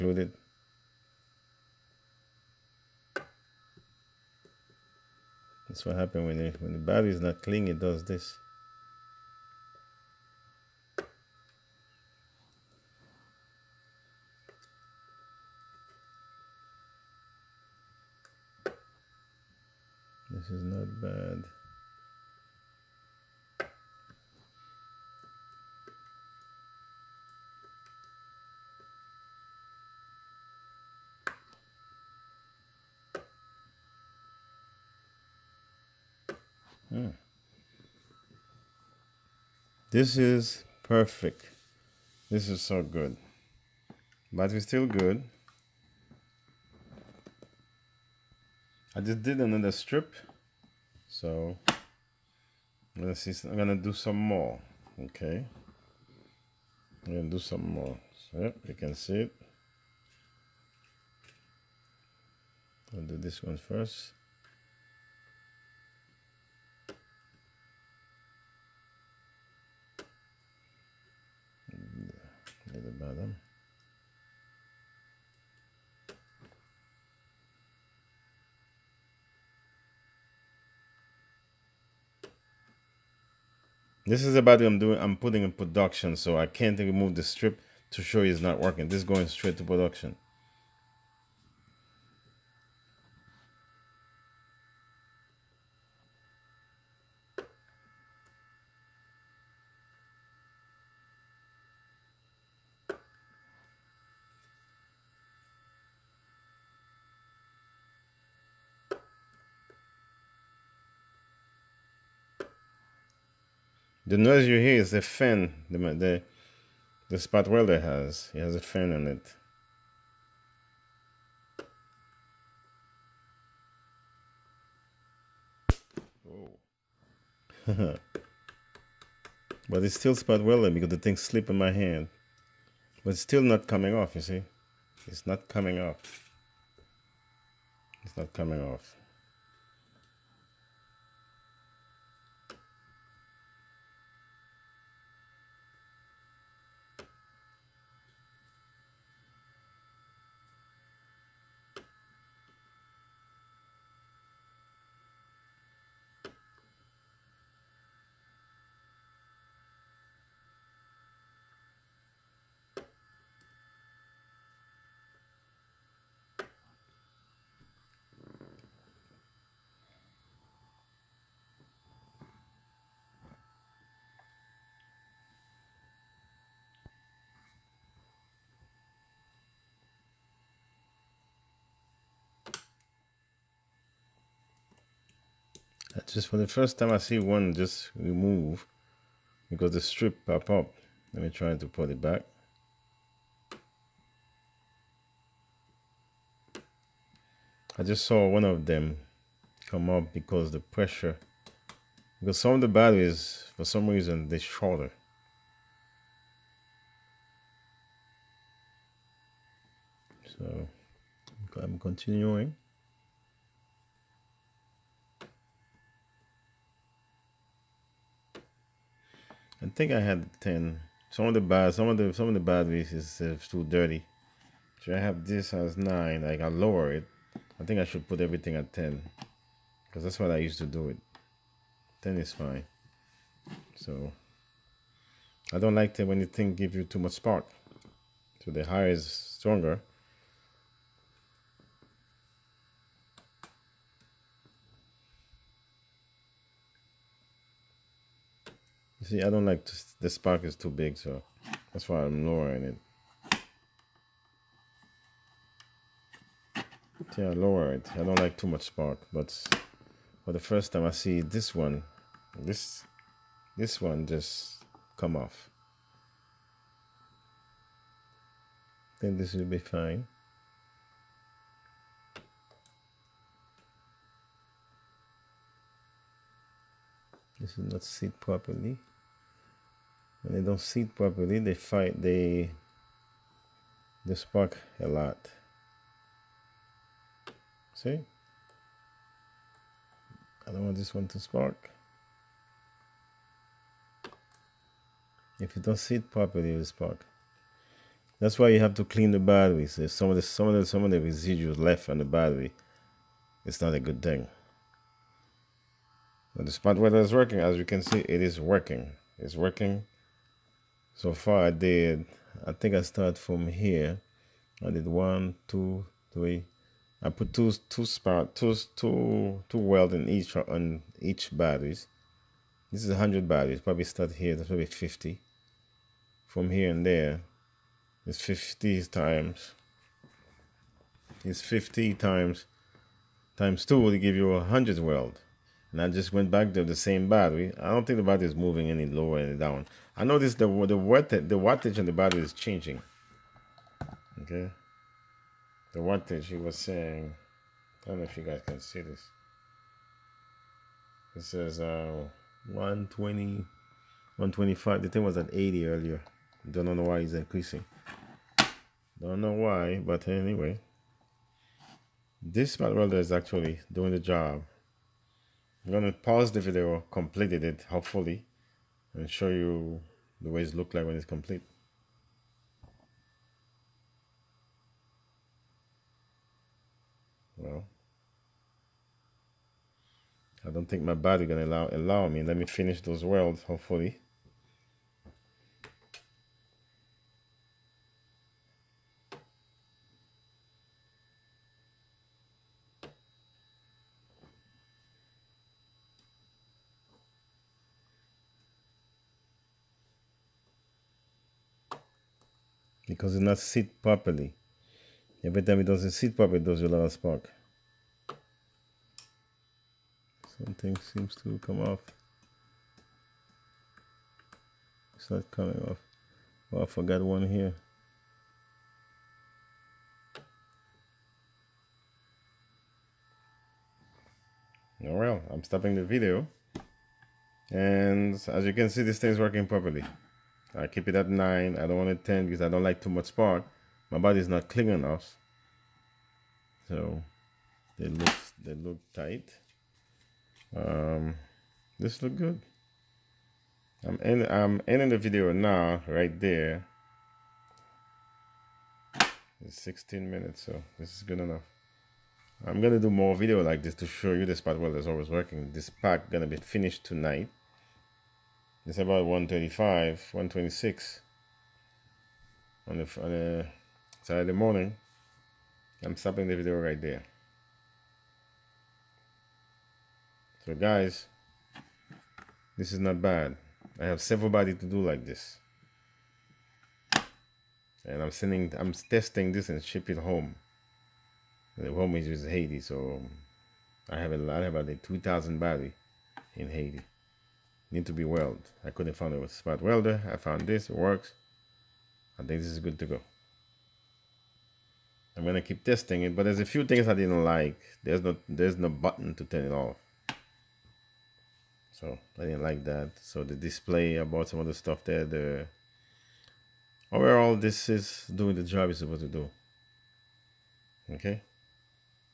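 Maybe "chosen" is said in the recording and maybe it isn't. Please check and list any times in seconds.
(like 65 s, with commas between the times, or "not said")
not said.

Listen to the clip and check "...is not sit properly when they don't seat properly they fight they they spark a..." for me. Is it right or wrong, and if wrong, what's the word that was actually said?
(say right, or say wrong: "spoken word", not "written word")
right.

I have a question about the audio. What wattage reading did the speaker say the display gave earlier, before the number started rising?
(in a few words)
80.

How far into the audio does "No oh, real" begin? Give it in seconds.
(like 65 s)
424 s.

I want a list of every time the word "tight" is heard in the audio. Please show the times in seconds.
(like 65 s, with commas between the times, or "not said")
438 s.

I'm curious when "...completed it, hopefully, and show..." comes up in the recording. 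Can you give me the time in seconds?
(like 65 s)
366 s.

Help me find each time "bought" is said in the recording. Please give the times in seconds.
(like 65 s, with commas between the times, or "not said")
504 s.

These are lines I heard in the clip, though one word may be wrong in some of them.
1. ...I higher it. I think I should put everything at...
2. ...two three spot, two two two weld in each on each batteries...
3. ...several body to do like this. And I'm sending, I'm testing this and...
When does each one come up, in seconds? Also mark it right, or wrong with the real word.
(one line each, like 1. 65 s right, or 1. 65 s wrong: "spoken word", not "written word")
1. 226 s wrong: "lower", not "higher"
2. 317 s wrong: "two", not "three"
3. 474 s right.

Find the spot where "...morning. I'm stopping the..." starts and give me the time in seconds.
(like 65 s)
464 s.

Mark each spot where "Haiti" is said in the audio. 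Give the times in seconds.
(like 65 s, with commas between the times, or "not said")
482 s, 486 s.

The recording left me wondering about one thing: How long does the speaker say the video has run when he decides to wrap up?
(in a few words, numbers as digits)
16 minutes.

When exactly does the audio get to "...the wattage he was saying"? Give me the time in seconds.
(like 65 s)
345 s.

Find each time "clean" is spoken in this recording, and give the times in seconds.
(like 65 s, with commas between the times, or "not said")
7 s, 298 s, 434 s.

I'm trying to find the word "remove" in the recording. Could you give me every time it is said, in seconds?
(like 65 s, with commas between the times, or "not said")
86 s, 187 s.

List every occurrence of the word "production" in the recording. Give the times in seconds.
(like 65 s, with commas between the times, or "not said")
85 s, 89 s.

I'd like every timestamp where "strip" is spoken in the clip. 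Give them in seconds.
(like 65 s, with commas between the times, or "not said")
49 s, 87 s, 189 s.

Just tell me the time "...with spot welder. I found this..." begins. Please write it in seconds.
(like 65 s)
489 s.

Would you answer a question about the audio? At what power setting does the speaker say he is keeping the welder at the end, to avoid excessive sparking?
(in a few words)
9.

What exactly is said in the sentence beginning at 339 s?
I noticed the the watt the wattage on the battery is changing.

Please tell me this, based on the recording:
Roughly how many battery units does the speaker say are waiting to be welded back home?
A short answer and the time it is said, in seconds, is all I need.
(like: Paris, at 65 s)
2,000, at 484 s.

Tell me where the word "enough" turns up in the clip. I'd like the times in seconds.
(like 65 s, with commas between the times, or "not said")
434 s, 451 s.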